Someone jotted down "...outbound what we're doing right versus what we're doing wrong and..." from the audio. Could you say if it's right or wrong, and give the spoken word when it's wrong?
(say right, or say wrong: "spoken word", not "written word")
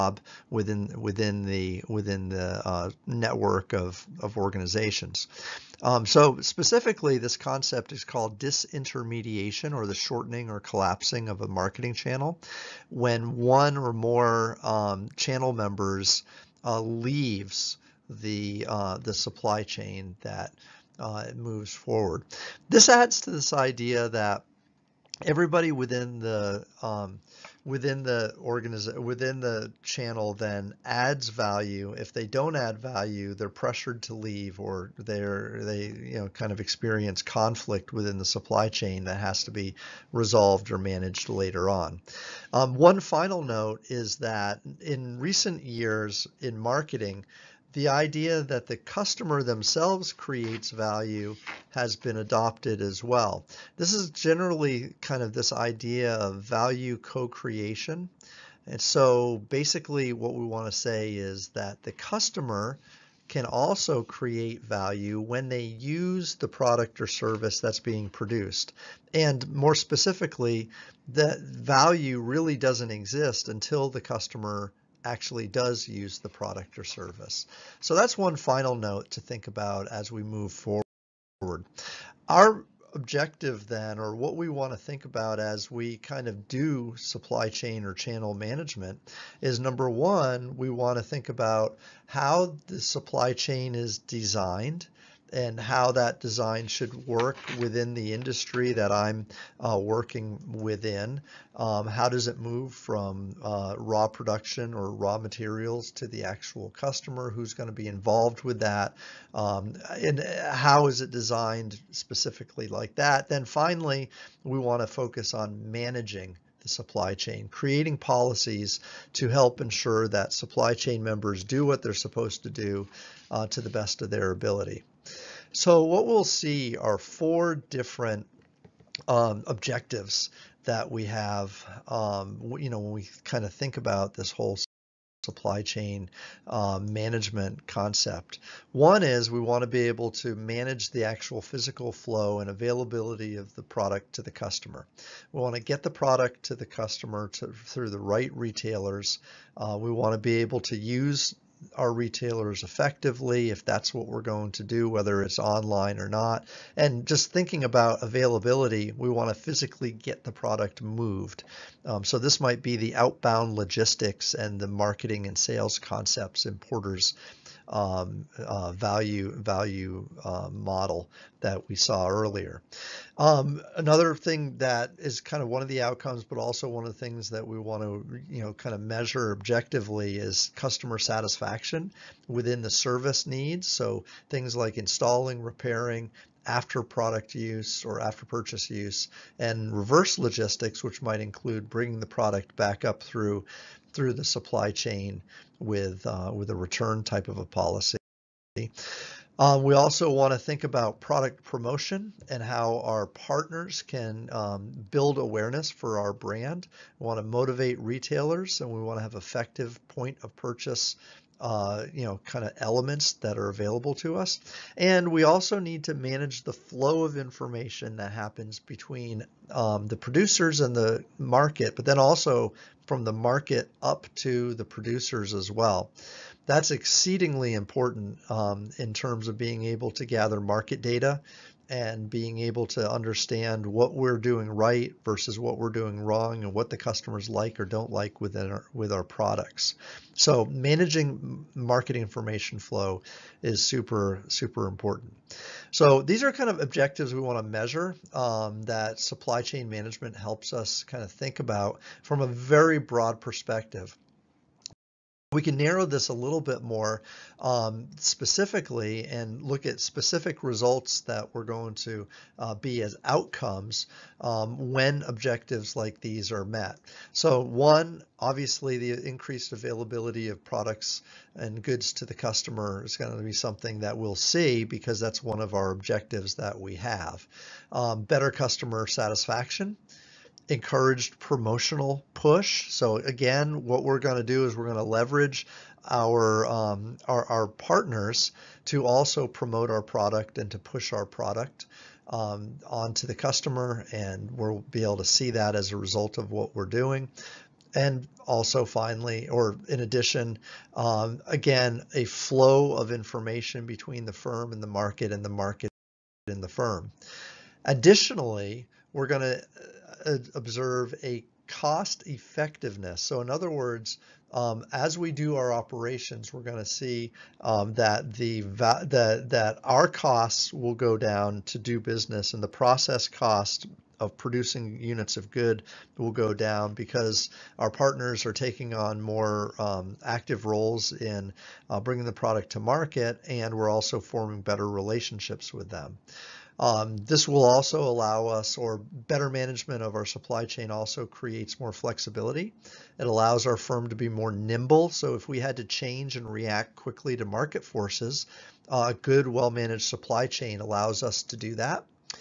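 wrong: "understand", not "outbound".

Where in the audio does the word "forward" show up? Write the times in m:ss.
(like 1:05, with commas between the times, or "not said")
0:21, 1:20.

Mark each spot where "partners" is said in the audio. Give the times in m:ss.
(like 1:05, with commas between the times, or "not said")
3:23, 4:47, 5:27.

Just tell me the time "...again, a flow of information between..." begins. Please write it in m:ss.
5:01.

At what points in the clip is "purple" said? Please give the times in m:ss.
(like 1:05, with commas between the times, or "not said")
not said.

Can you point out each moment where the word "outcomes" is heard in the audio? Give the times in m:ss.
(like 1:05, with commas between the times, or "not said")
2:55, 4:23.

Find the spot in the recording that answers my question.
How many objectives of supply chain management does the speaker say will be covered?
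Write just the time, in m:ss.
2:06.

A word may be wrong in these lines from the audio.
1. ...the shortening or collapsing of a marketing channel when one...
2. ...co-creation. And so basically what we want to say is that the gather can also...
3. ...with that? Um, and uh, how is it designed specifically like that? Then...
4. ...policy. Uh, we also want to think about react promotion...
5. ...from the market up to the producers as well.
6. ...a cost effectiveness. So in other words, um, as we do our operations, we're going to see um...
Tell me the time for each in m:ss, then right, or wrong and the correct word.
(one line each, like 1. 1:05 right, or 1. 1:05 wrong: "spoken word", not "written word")
1. 0:09 right
2. 0:56 wrong: "customer", not "gather"
3. 1:48 right
4. 3:17 wrong: "product", not "react"
5. 3:42 right
6. 5:11 right.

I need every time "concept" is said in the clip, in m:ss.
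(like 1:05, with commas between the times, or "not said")
0:07, 2:17, 2:45.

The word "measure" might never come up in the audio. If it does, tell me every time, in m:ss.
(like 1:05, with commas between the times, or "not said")
2:58, 4:07.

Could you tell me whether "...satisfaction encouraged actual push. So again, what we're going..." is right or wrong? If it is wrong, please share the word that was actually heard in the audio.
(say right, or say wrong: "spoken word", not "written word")
wrong: "promotional", not "actual".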